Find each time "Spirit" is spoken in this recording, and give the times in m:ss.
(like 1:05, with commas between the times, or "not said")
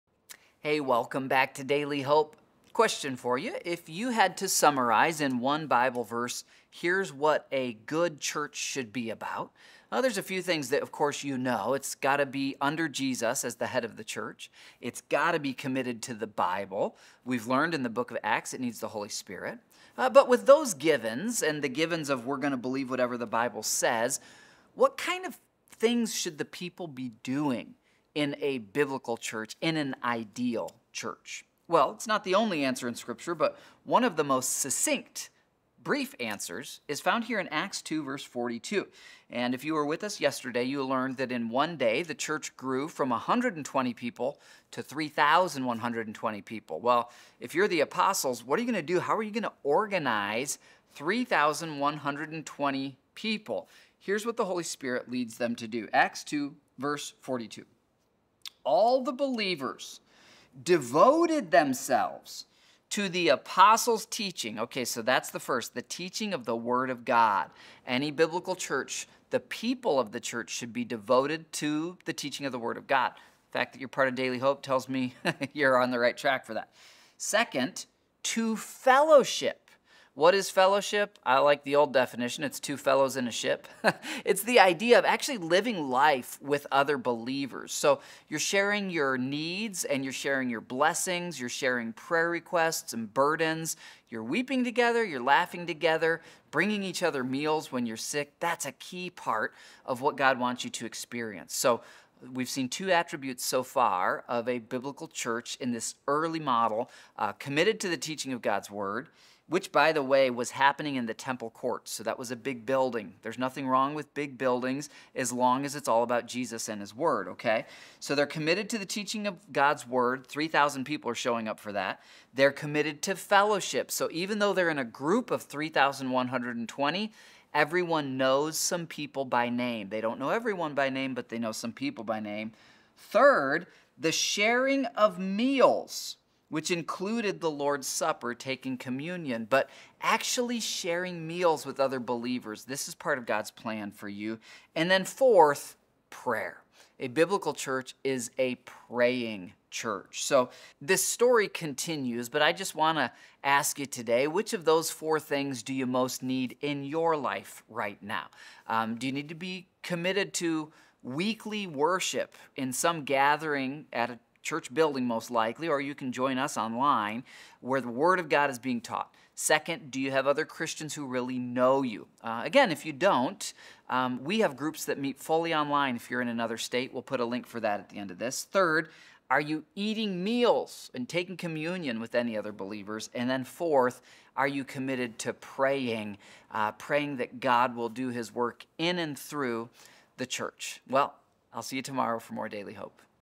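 0:19, 0:54.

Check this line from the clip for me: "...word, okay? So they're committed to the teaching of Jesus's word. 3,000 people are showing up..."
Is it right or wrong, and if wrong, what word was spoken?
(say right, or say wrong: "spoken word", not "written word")
wrong: "God", not "Jesus".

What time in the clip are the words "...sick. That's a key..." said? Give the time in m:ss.
1:37.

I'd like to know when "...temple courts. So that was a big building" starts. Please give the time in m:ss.
1:51.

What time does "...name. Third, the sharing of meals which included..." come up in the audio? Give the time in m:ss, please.
2:12.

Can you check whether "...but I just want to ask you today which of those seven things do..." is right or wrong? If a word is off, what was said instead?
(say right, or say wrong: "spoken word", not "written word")
wrong: "four", not "seven".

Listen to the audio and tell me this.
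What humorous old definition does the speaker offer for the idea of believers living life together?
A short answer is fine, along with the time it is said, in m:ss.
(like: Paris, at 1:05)
two fellows in a ship, at 1:22.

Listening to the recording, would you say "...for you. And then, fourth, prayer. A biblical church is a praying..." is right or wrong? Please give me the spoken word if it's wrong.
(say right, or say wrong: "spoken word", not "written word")
right.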